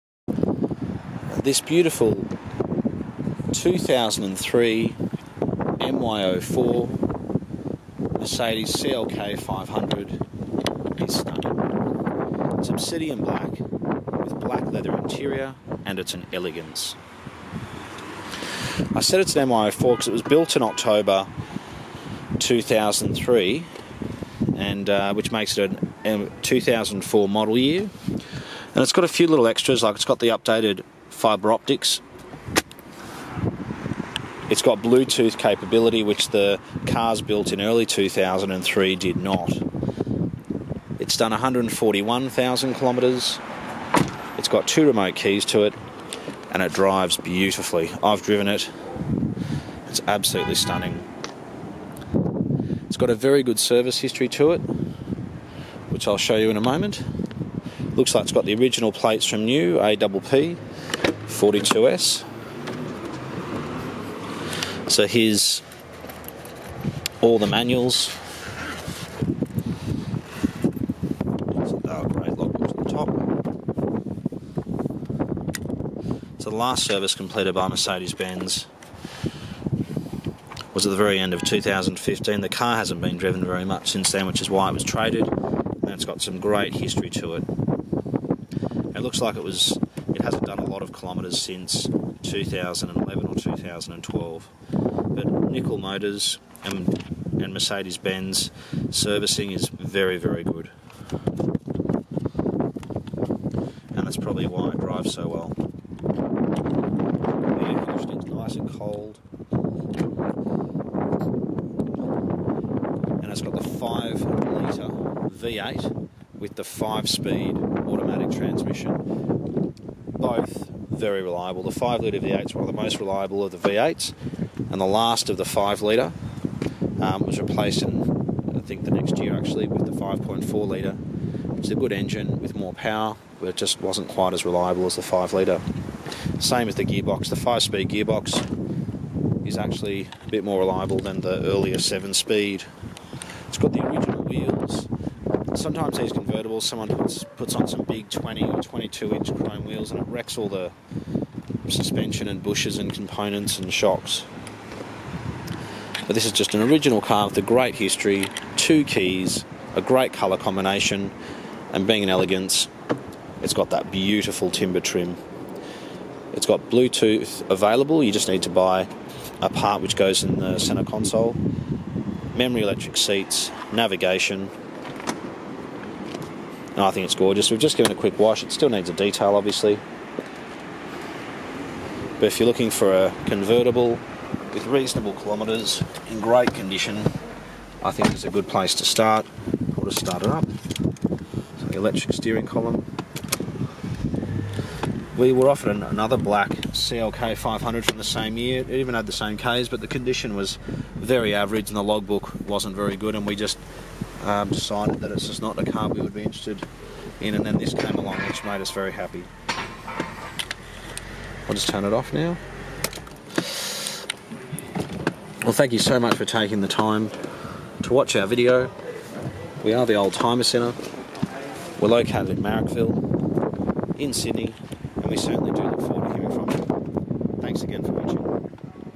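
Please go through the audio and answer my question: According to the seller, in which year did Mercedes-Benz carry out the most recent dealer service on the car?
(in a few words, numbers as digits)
2015.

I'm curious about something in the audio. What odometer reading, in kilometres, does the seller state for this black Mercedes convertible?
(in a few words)
141,000 kilometres.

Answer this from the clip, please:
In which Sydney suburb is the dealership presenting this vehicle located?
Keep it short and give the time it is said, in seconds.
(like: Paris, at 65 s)
Marrickville, at 222 s.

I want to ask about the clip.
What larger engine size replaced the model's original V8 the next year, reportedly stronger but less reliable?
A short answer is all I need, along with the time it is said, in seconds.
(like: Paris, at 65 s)
5.4 litre, at 129 s.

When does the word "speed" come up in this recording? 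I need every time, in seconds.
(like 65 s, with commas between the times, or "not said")
116 s, 137 s, 142 s.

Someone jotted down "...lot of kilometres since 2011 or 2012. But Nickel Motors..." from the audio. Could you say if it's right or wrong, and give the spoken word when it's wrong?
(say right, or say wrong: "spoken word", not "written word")
right.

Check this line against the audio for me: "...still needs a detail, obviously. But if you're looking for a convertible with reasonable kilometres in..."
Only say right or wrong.
right.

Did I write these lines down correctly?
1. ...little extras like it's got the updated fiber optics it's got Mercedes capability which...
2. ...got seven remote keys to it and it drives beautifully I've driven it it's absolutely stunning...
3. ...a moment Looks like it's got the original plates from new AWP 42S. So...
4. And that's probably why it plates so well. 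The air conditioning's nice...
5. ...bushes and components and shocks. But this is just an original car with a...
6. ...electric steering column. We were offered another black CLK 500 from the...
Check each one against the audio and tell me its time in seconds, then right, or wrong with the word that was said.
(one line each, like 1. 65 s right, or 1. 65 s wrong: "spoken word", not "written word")
1. 29 s wrong: "Bluetooth", not "Mercedes"
2. 44 s wrong: "two", not "seven"
3. 56 s right
4. 103 s wrong: "drives", not "plates"
5. 152 s right
6. 191 s right.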